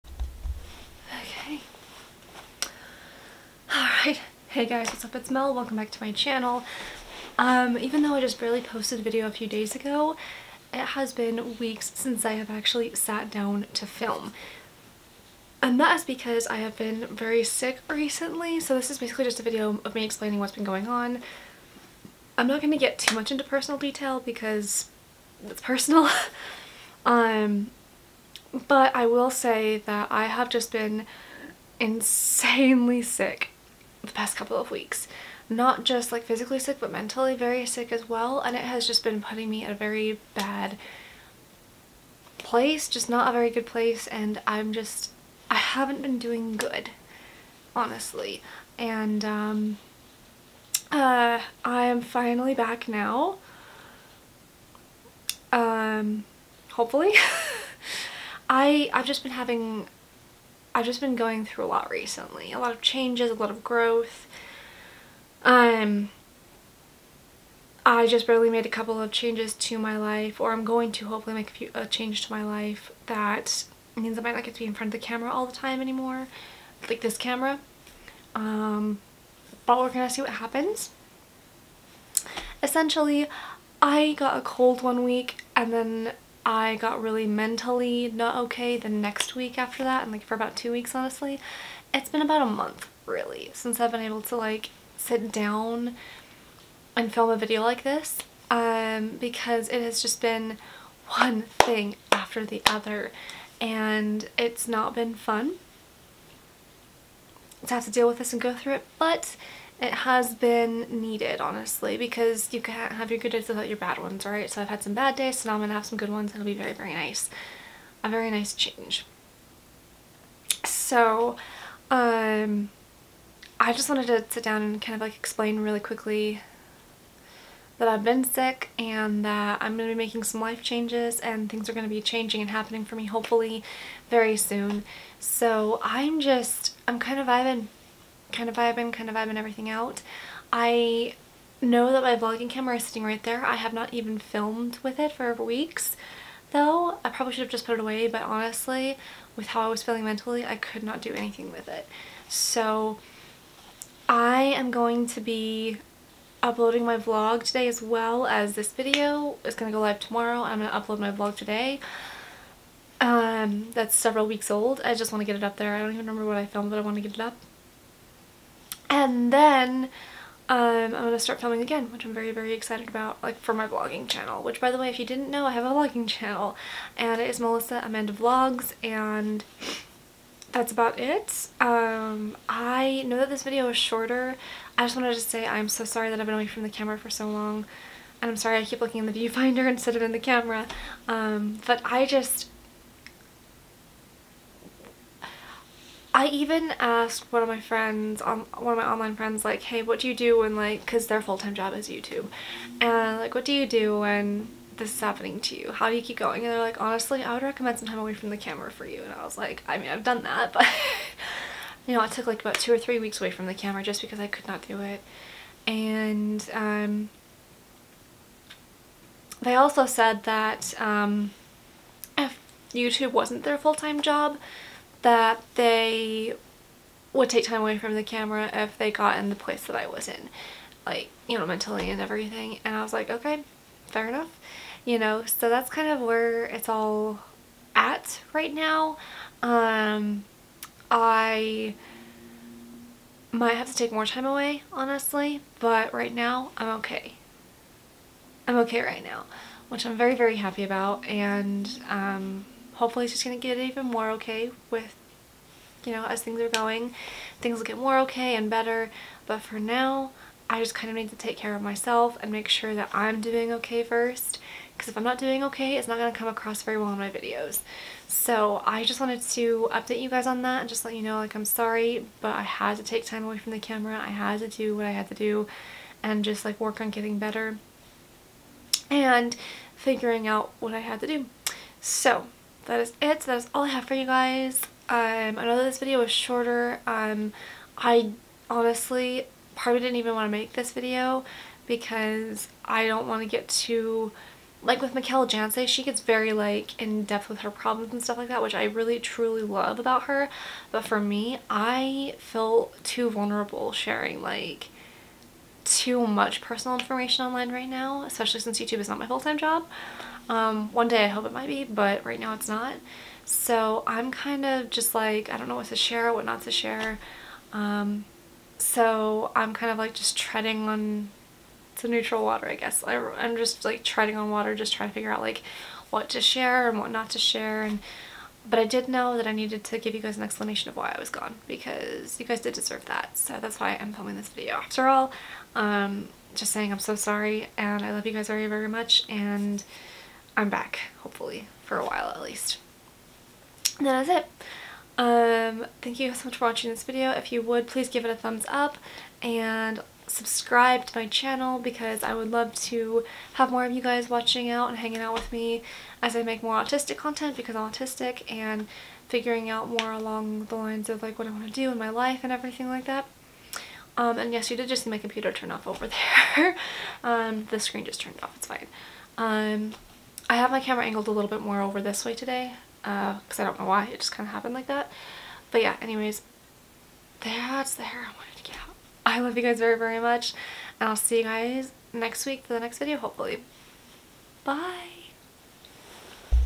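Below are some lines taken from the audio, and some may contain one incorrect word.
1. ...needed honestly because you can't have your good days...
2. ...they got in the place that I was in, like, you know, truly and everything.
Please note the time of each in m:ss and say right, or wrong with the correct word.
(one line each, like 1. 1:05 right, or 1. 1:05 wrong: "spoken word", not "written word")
1. 1:51 right
2. 3:48 wrong: "mentally", not "truly".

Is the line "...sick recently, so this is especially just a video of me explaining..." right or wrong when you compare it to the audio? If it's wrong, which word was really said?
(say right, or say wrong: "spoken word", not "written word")
wrong: "basically", not "especially".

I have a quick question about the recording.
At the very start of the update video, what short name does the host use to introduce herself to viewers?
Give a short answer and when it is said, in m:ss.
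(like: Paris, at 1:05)
Mel, at 0:05.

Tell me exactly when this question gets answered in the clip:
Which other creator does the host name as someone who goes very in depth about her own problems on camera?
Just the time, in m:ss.
4:54.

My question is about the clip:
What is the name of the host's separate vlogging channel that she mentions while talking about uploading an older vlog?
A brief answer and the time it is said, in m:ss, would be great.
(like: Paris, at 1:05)
Melissa Amanda Vlogs, at 2:57.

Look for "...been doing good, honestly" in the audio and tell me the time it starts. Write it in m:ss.
0:46.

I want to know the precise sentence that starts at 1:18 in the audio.
Um, but we're gonna see what happens.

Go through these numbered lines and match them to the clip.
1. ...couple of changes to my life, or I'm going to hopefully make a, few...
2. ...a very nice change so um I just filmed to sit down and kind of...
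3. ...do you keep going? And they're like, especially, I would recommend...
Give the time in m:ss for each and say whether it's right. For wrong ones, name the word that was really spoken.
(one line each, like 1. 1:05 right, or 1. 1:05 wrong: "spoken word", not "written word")
1. 1:08 right
2. 1:58 wrong: "wanted", not "filmed"
3. 3:25 wrong: "honestly", not "especially".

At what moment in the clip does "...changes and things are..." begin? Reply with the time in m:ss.
2:10.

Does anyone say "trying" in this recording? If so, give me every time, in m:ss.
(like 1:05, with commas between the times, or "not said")
5:24.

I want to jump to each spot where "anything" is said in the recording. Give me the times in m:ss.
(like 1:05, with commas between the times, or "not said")
2:31.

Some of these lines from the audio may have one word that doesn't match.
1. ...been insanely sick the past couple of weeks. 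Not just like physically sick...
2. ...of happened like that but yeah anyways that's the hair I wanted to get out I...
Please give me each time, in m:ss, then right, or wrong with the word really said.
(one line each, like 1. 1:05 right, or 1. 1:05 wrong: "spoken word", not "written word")
1. 0:30 right
2. 6:14 right.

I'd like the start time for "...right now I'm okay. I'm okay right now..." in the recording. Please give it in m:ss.
4:05.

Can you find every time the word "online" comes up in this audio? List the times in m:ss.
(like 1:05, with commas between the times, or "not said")
3:18, 5:07.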